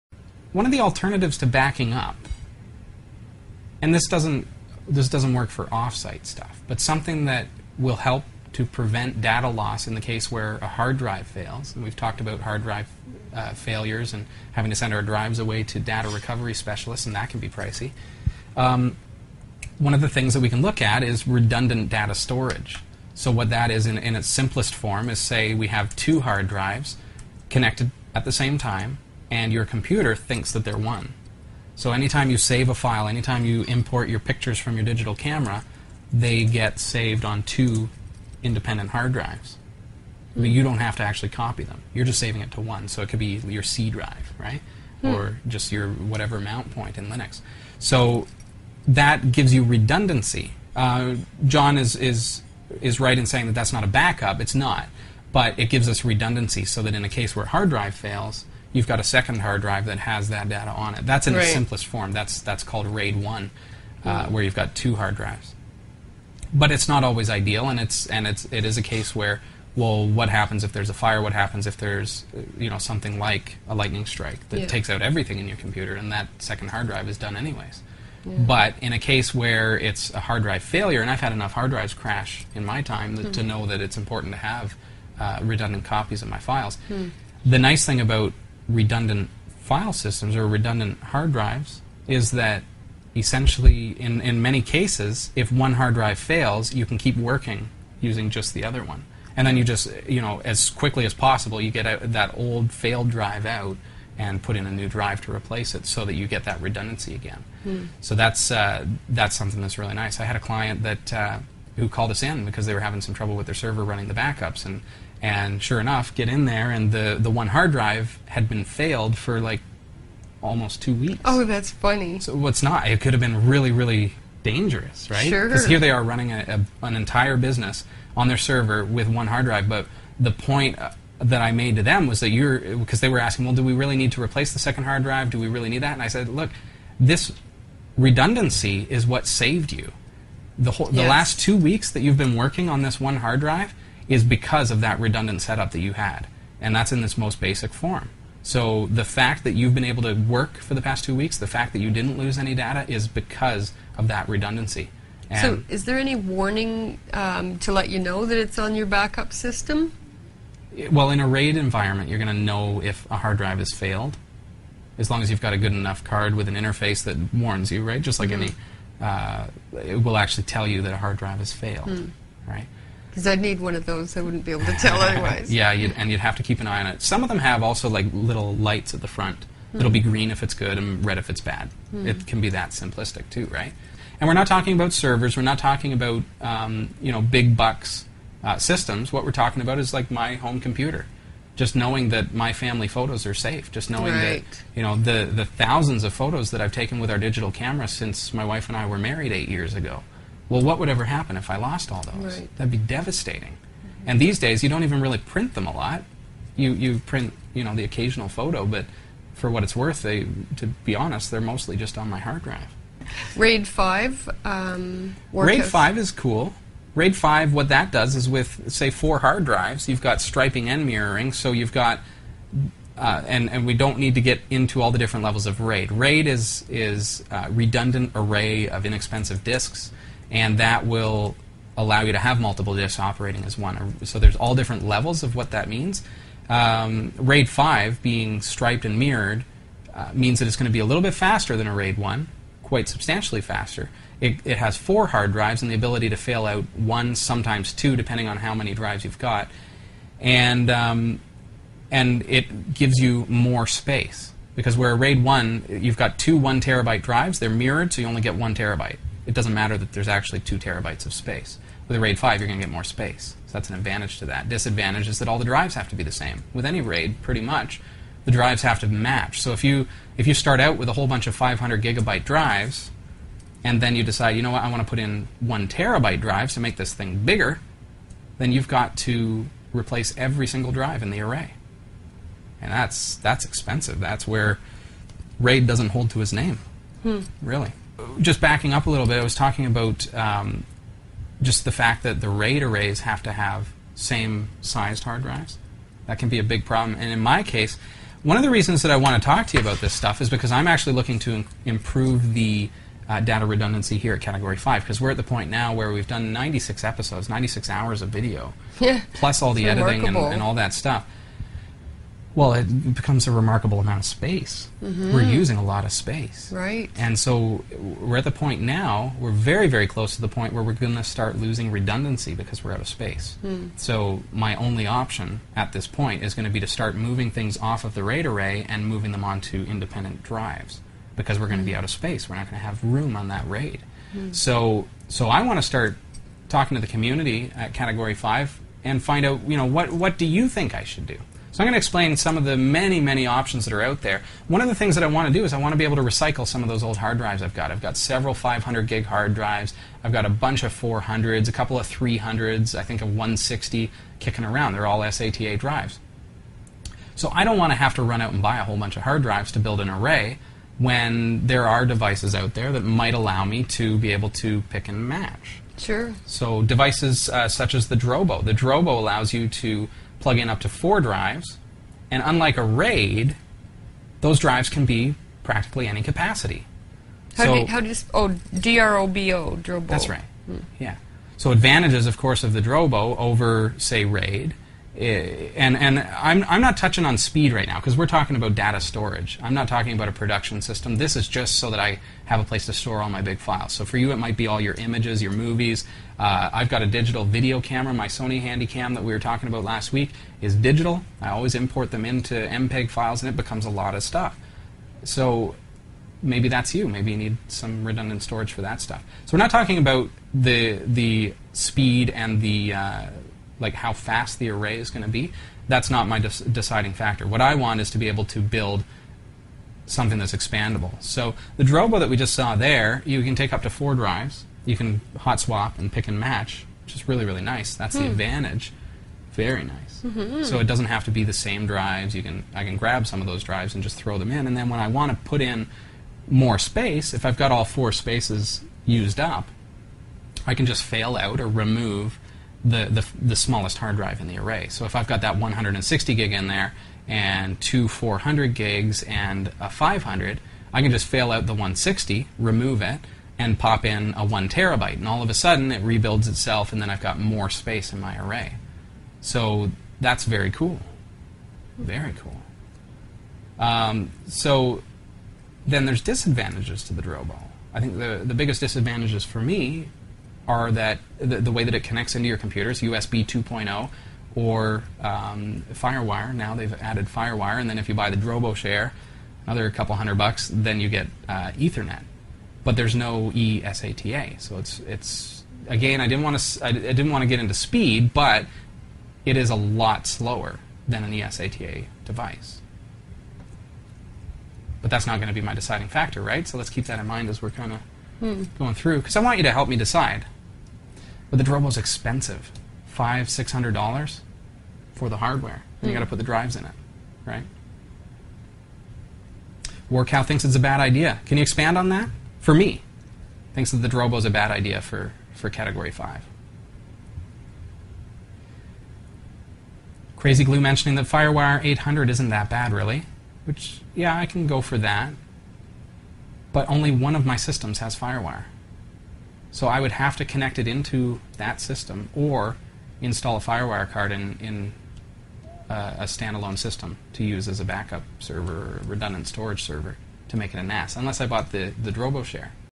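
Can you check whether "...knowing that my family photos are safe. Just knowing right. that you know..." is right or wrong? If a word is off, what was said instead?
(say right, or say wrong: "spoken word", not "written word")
right.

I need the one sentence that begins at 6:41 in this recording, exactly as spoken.
I always import them into MPEG files, and it becomes a lot of stuff.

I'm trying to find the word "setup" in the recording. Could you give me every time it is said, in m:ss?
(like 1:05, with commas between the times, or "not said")
2:25.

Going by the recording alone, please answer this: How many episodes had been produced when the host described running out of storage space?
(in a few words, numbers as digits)
96.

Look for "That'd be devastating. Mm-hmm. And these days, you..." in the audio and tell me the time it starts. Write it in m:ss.
3:22.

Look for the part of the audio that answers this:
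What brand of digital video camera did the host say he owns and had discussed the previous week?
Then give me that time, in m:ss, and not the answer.
6:38.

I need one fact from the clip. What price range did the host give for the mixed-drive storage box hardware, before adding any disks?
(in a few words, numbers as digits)
$500-600.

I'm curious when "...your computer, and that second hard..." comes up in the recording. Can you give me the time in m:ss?
1:15.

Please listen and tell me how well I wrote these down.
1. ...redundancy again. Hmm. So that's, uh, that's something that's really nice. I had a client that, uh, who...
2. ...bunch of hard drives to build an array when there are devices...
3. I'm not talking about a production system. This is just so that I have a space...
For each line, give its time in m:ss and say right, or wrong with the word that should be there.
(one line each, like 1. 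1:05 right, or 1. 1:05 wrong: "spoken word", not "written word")
1. 1:46 right
2. 5:58 right
3. 6:29 wrong: "place", not "space".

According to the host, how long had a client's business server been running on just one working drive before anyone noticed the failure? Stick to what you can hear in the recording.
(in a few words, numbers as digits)
almost two weeks.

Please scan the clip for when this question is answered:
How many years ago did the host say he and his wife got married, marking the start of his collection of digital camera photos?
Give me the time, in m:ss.
3:19.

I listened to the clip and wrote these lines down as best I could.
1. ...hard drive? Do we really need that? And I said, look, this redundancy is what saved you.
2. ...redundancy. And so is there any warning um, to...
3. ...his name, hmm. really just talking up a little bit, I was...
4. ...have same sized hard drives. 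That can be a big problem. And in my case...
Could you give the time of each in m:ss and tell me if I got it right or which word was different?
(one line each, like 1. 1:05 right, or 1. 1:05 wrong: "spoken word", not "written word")
1. 2:14 right
2. 2:34 right
3. 4:46 wrong: "backing", not "talking"
4. 4:53 right.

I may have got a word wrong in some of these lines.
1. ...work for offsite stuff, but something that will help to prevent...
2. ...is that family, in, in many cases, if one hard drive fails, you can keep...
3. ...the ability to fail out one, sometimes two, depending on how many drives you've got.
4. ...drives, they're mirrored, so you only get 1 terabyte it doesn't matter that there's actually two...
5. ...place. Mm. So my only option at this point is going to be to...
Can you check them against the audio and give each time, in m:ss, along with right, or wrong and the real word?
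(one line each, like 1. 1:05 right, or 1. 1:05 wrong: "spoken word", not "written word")
1. 0:05 right
2. 1:32 wrong: "essentially", not "family"
3. 4:05 right
4. 4:17 right
5. 5:22 wrong: "space", not "place".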